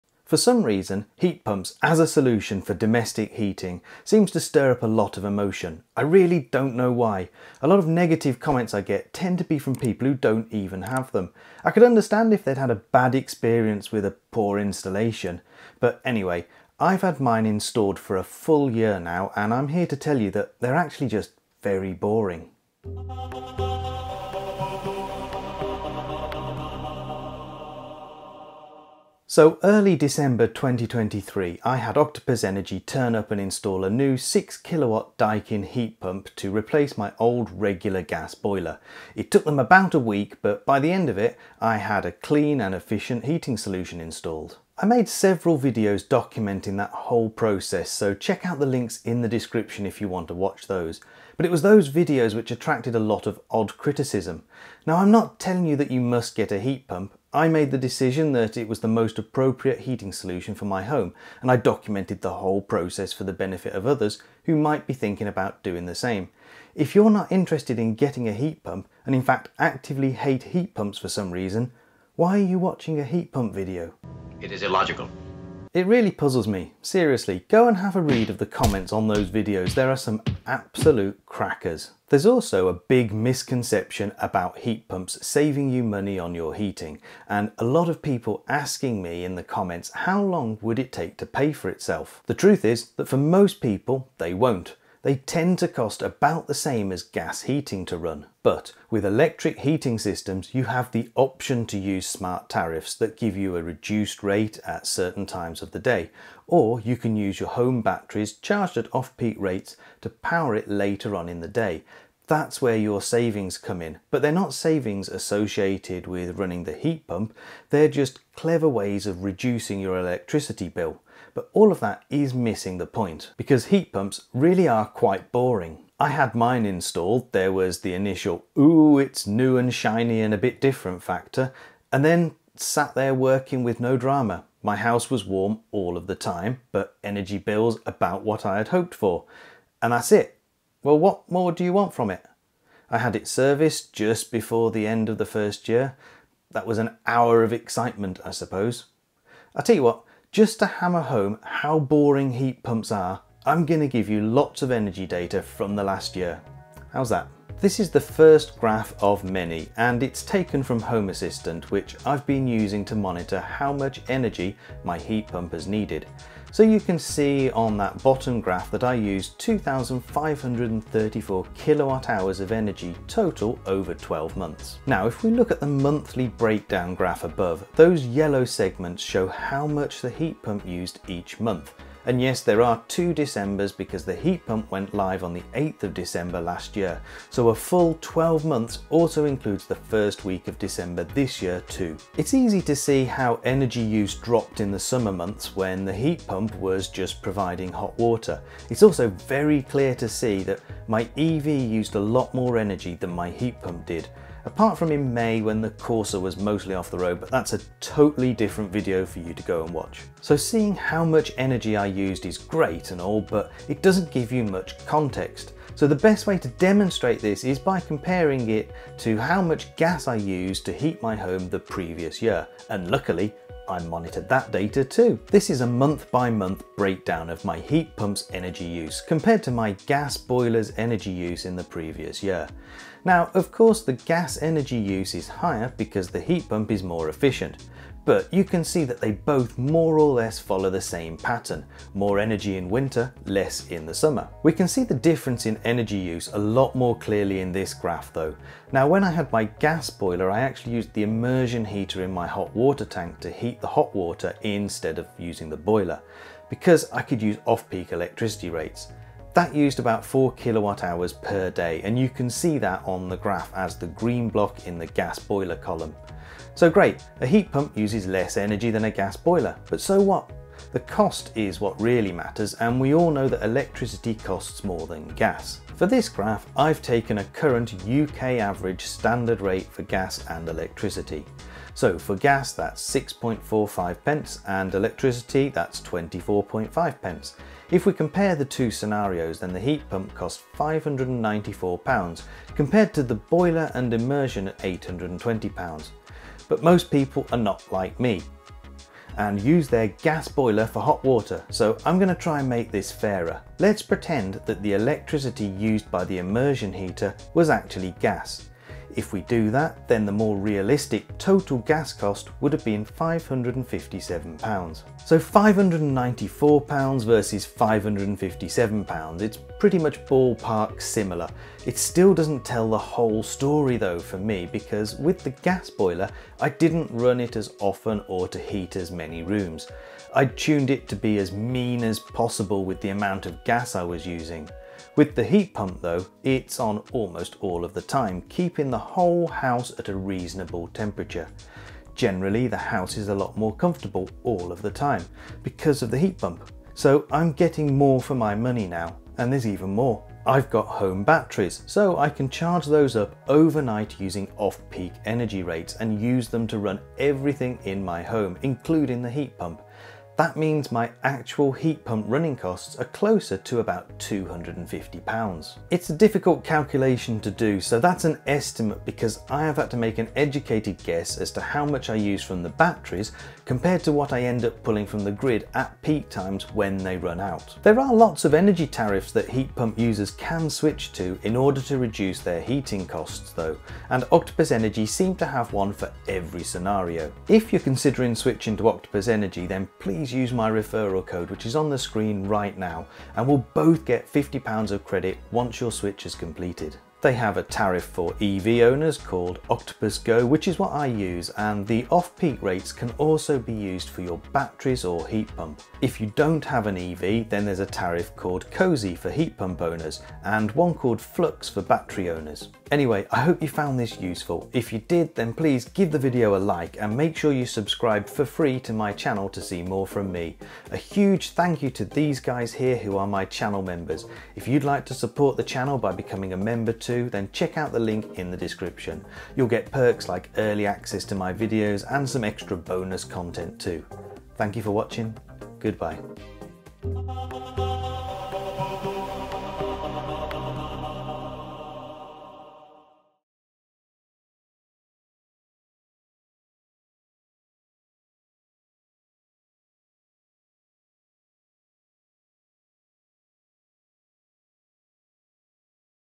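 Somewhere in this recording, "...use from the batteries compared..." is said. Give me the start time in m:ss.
6:11.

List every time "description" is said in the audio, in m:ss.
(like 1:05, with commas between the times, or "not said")
0:49, 7:08.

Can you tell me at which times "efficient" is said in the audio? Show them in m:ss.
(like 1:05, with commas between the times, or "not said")
0:42, 3:57.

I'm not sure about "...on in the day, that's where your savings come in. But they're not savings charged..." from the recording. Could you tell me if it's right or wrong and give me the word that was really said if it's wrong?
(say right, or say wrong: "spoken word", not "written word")
wrong: "associated", not "charged".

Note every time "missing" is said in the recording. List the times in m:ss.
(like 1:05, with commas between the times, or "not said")
2:02.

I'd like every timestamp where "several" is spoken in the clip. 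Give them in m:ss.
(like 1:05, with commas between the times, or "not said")
0:45.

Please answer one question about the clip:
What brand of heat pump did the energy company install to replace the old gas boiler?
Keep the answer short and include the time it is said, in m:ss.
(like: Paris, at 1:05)
Daikin, at 0:35.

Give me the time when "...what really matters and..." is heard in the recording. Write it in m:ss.
4:31.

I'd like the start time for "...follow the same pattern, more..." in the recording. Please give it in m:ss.
4:00.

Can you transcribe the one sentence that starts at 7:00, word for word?
A huge thank you to these guys here who are my channel members.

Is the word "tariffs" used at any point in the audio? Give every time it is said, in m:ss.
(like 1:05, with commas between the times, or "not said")
1:42, 6:18, 6:37, 6:47.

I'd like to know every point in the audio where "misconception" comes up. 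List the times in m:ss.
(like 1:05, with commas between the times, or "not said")
1:23.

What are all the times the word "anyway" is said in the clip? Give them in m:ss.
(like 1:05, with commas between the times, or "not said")
0:16, 6:52.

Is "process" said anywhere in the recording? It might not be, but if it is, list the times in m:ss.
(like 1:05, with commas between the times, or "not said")
0:47, 1:02.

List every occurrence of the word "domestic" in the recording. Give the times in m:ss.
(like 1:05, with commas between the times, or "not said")
0:02.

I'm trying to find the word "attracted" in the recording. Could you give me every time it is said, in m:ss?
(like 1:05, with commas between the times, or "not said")
0:52.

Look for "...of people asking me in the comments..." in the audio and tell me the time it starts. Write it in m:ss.
1:27.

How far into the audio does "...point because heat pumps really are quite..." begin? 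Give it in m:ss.
2:02.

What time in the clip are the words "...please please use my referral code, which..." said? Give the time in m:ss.
6:29.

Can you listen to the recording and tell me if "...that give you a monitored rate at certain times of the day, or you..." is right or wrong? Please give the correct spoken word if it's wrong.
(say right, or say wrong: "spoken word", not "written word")
wrong: "reduced", not "monitored".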